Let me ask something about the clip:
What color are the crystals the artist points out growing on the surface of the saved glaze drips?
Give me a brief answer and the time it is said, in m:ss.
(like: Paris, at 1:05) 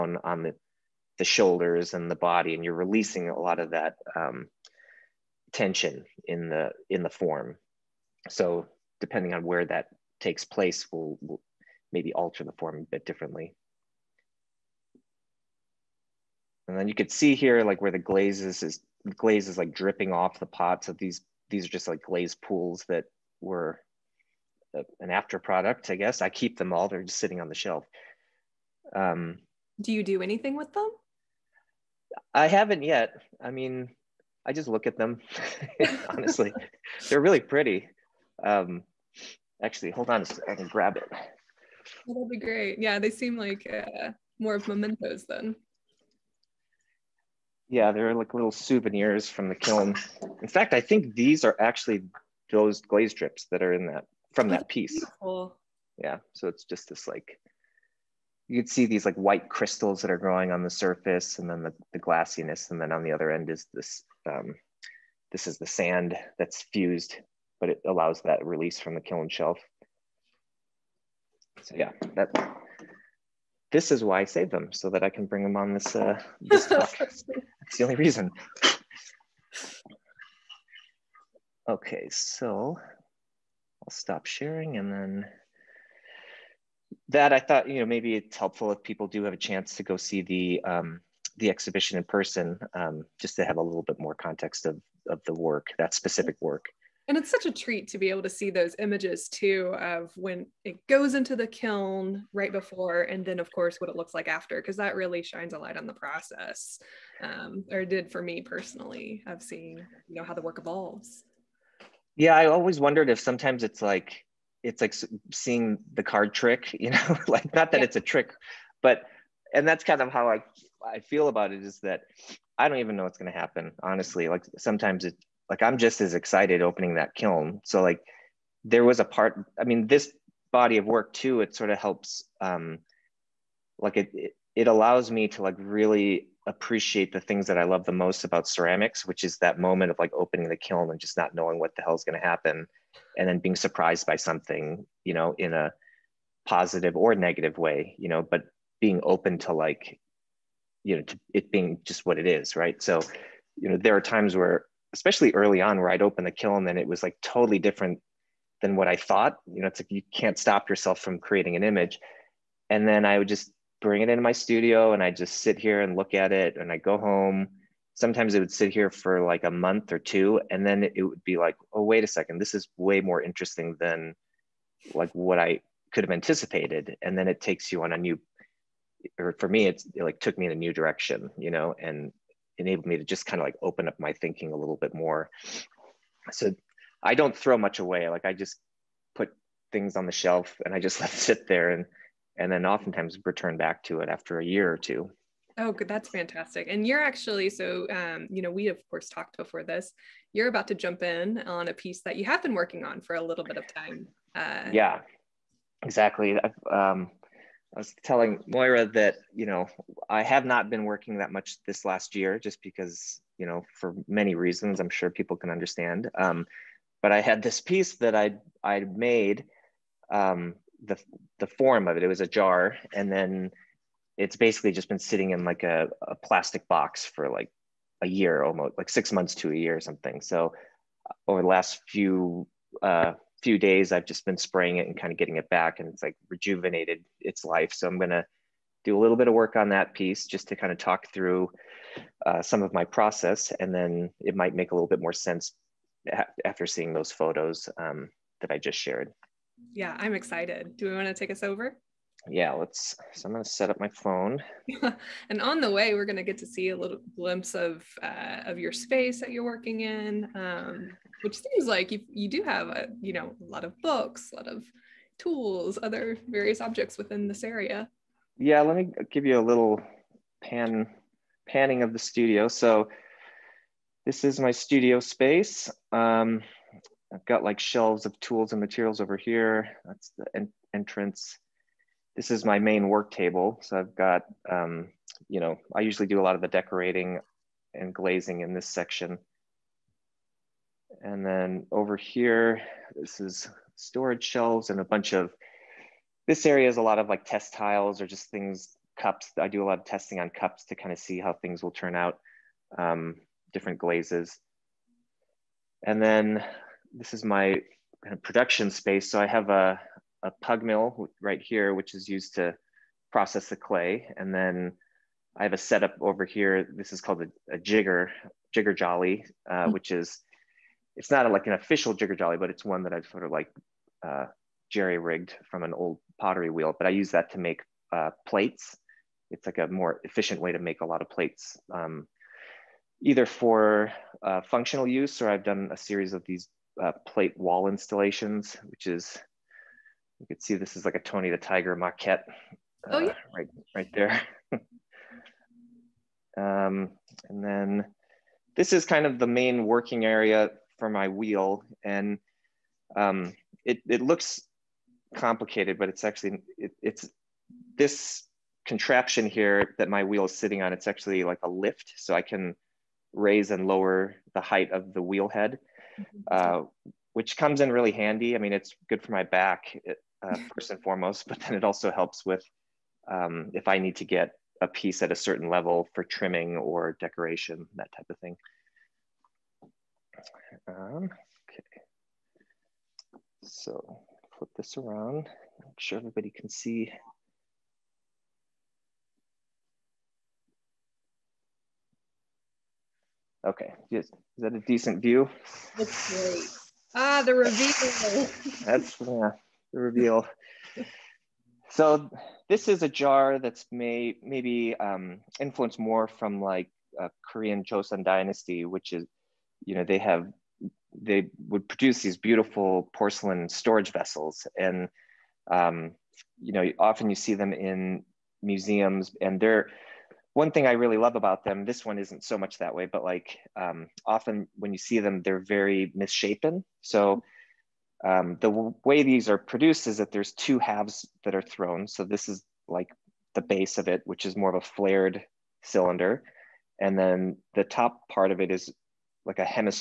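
white, at 0:59.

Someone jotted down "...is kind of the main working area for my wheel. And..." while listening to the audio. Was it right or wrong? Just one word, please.
right.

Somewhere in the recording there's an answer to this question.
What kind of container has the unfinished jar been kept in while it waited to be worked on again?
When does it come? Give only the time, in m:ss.
3:45.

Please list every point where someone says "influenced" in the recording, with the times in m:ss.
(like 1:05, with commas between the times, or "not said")
6:45.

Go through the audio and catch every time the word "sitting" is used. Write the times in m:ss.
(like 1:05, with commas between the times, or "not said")
0:27, 3:44, 6:00.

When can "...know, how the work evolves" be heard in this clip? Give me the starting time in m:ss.
1:50.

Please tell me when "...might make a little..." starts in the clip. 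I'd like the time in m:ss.
4:04.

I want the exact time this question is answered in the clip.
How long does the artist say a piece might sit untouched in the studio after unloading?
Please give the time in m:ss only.
2:49.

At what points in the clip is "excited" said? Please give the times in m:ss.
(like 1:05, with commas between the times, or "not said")
2:06, 4:10.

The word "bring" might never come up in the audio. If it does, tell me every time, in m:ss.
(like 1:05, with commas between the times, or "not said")
1:15, 2:43.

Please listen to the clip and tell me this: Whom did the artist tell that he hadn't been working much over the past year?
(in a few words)
Moira.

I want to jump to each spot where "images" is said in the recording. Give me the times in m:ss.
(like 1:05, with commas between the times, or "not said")
1:38, 2:41.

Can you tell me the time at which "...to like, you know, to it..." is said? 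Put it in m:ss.
2:29.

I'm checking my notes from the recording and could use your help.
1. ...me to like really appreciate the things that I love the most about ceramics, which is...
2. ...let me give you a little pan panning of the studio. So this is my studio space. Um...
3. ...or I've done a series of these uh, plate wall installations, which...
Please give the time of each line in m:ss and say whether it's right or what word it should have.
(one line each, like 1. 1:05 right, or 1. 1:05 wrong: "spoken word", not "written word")
1. 2:15 right
2. 4:28 right
3. 5:35 right.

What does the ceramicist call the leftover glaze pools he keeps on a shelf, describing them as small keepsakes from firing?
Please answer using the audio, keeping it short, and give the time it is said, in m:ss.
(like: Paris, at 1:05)
little souvenirs from the kiln, at 0:48.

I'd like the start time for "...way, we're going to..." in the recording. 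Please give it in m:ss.
4:15.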